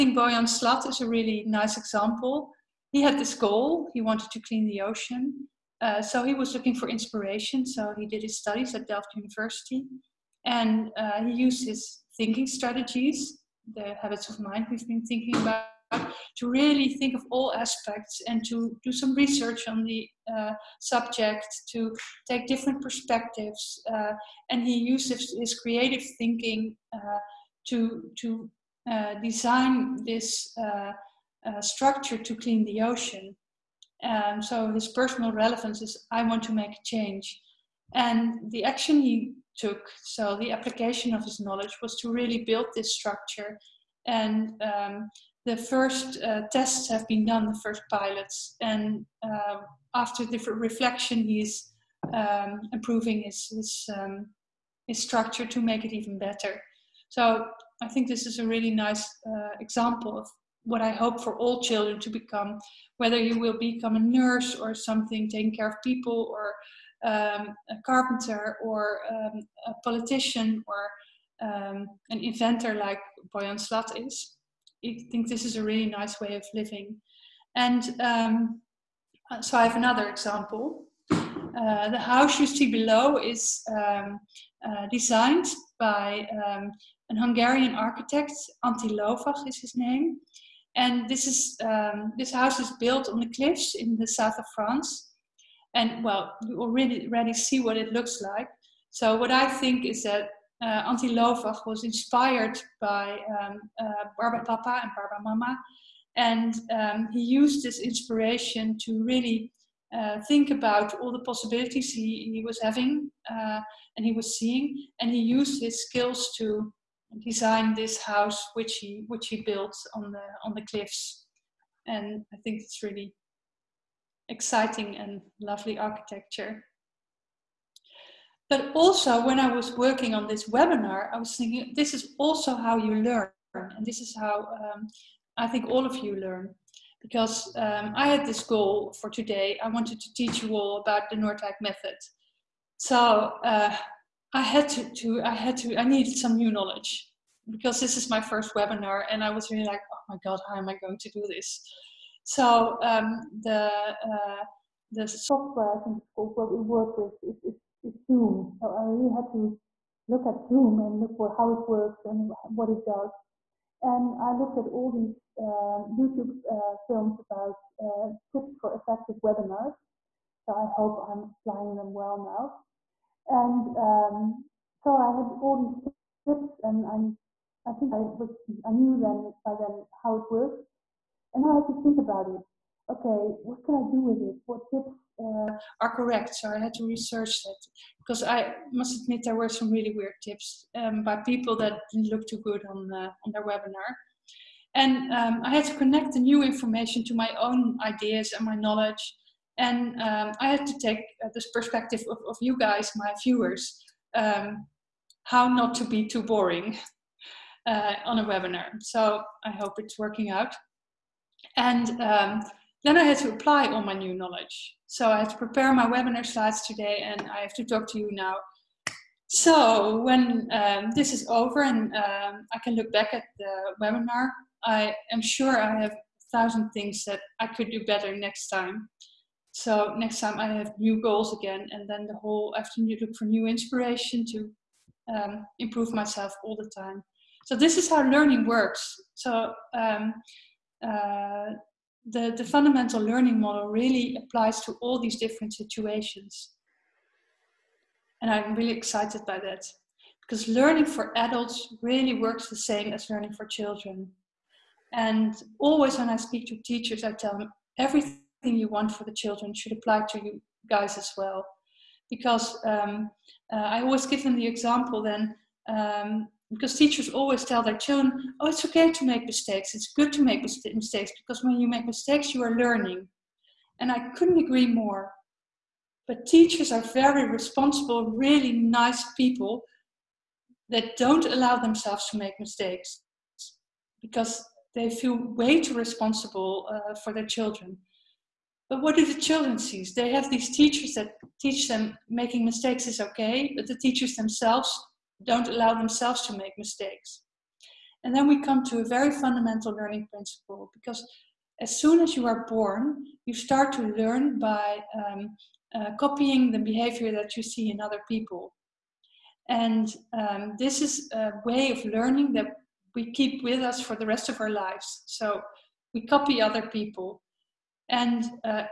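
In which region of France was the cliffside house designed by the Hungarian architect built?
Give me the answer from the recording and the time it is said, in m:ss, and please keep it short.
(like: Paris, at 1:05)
the south of France, at 1:34.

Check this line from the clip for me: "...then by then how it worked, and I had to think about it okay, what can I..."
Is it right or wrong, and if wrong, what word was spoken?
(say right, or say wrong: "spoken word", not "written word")
right.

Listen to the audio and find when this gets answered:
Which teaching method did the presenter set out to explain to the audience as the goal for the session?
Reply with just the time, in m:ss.
2:21.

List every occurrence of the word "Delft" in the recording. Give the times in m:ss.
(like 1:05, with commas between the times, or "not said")
0:08.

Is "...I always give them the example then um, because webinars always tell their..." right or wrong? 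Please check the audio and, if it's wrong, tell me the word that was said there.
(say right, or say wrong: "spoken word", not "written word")
wrong: "teachers", not "webinars".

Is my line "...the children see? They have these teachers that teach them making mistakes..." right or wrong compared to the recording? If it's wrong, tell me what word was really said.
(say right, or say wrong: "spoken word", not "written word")
right.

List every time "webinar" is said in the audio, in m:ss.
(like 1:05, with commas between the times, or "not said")
2:10, 2:28, 2:49, 3:13, 3:28, 3:35, 3:43.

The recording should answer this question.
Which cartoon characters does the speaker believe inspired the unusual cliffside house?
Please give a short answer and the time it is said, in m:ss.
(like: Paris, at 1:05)
Barba Papa and Barba Mama, at 1:44.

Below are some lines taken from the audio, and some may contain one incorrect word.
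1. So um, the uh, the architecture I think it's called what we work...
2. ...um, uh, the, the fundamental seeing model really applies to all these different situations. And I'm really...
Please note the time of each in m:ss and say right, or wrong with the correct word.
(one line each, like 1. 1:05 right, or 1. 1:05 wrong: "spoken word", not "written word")
1. 2:32 wrong: "software", not "architecture"
2. 3:59 wrong: "learning", not "seeing".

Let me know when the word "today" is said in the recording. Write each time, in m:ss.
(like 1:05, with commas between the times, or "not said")
2:19, 3:36.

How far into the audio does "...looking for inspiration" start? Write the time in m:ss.
0:06.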